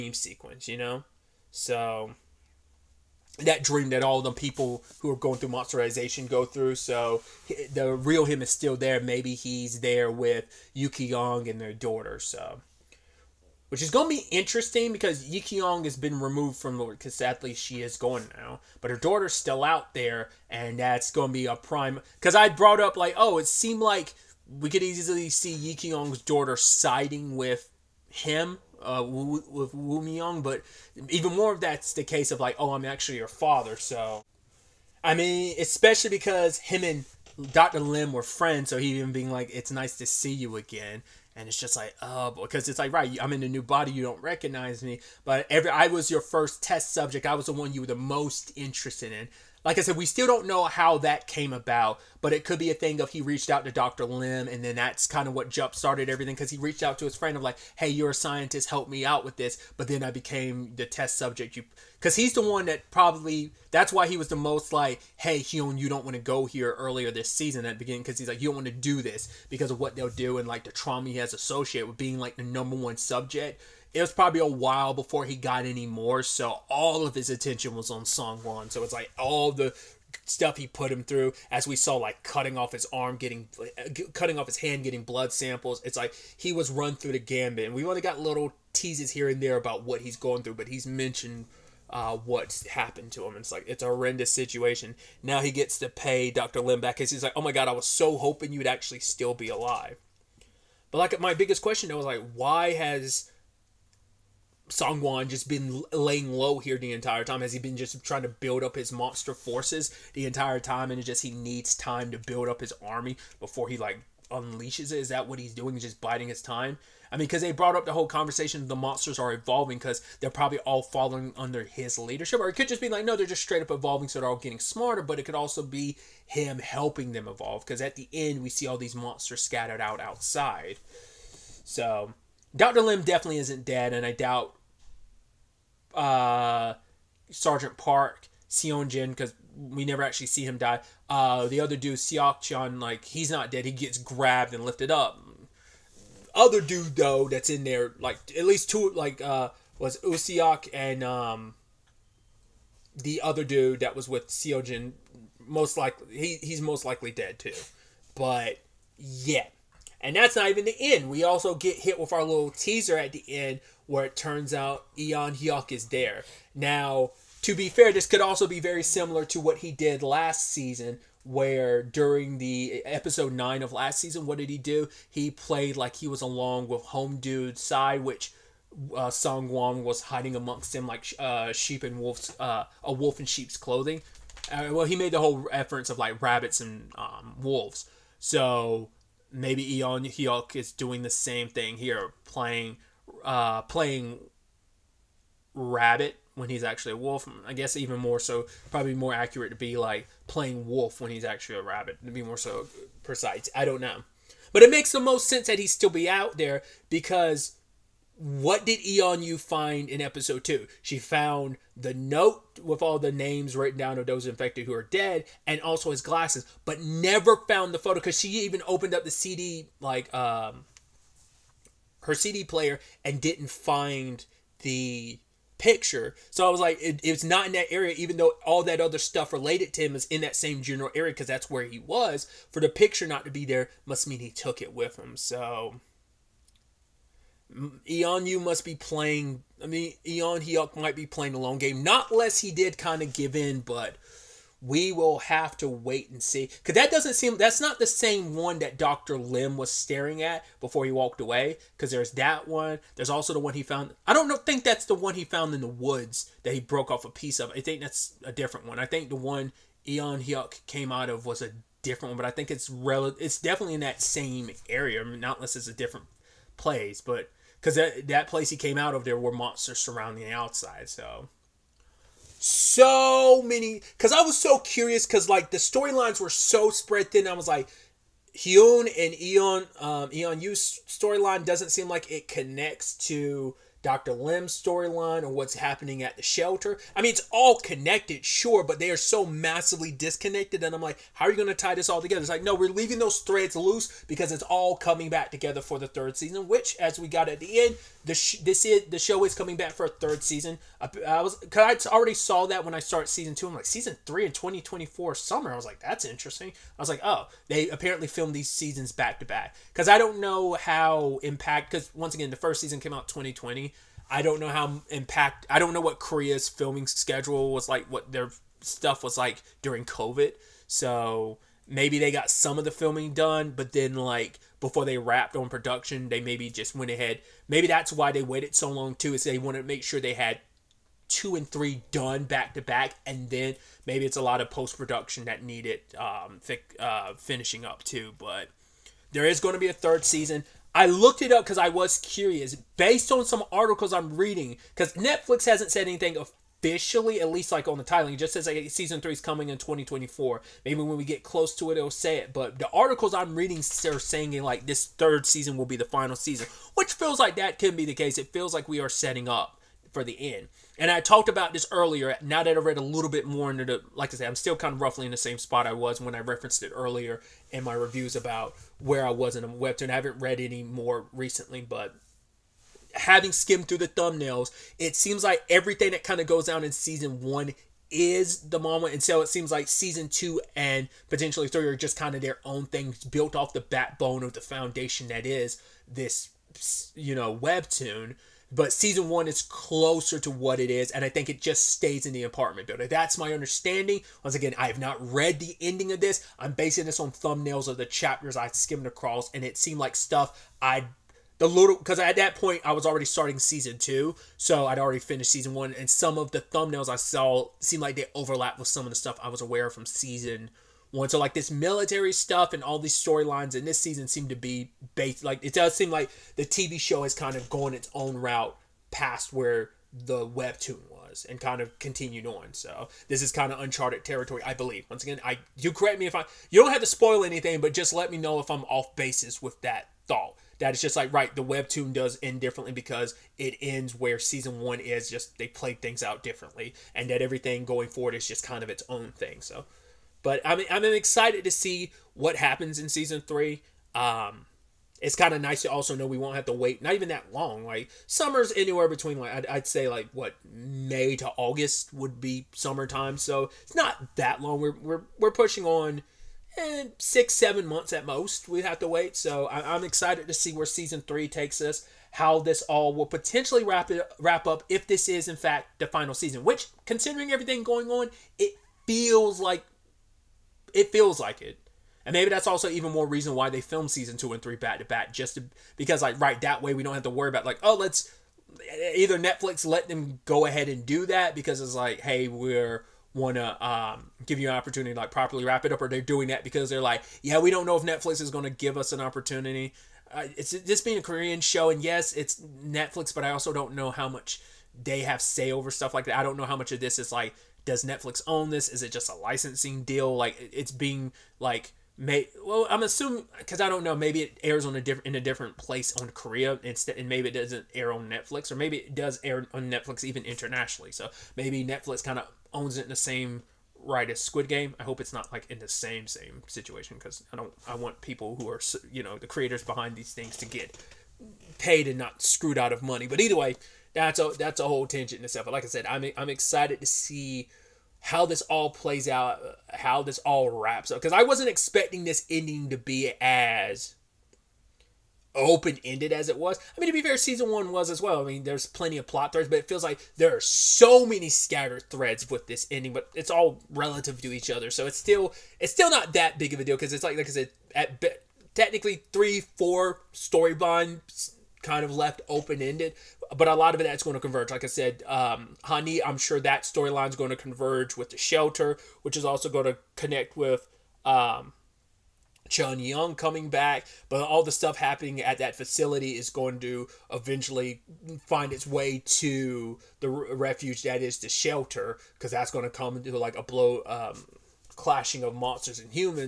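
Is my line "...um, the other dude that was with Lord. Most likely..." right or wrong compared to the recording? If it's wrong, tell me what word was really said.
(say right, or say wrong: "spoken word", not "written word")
wrong: "Seongjin", not "Lord".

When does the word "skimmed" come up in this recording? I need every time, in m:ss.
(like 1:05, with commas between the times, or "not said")
6:13, 6:38.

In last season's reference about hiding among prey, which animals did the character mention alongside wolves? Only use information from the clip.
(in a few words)
Rabbits.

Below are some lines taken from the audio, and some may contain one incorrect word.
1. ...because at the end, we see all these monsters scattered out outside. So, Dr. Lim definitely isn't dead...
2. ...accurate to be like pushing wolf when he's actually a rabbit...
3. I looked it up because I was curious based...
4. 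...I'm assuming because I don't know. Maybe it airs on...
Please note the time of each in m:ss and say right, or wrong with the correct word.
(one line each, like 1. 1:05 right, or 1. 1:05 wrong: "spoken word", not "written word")
1. 2:07 right
2. 3:19 wrong: "playing", not "pushing"
3. 5:40 right
4. 8:22 right.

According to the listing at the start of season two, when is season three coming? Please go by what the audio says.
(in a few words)
Summer 2024.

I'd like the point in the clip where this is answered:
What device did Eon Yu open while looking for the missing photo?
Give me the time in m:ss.
3:42.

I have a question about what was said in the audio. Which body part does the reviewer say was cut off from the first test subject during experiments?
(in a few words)
Hand.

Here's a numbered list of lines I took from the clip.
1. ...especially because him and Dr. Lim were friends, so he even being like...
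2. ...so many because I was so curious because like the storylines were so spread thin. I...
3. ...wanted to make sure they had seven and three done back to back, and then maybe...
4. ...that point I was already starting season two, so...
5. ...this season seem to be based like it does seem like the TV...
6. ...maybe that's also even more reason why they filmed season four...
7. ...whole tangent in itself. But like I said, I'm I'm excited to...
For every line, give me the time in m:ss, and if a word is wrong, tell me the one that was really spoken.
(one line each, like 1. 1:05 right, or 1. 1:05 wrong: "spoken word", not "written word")
1. 0:35 right
2. 4:32 right
3. 5:29 wrong: "two", not "seven"
4. 6:42 right
5. 6:53 right
6. 7:52 wrong: "two", not "four"
7. 8:44 right.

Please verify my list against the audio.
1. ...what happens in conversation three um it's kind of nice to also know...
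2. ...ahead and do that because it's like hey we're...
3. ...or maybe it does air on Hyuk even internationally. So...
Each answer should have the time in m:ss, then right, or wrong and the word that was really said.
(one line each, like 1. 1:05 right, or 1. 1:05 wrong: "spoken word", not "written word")
1. 7:22 wrong: "season", not "conversation"
2. 8:00 right
3. 8:28 wrong: "Netflix", not "Hyuk".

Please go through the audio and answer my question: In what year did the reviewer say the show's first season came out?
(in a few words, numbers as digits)
2020.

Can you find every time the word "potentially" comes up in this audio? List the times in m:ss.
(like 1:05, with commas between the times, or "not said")
6:21, 7:43.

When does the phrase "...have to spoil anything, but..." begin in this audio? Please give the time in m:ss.
7:06.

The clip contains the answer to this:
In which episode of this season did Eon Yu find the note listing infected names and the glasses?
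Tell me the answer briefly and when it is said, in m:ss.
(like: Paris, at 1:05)
Episode 2, at 3:30.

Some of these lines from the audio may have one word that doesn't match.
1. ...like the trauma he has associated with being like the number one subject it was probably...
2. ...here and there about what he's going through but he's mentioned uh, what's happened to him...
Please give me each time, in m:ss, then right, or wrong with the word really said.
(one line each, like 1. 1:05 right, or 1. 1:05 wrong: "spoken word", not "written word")
1. 1:10 right
2. 1:29 right.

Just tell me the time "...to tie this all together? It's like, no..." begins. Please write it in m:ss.
4:51.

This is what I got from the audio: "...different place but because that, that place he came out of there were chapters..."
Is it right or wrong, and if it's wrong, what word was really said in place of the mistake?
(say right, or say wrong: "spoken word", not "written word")
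wrong: "monsters", not "chapters".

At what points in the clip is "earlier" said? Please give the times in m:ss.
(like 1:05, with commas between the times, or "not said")
1:06, 6:01, 6:06.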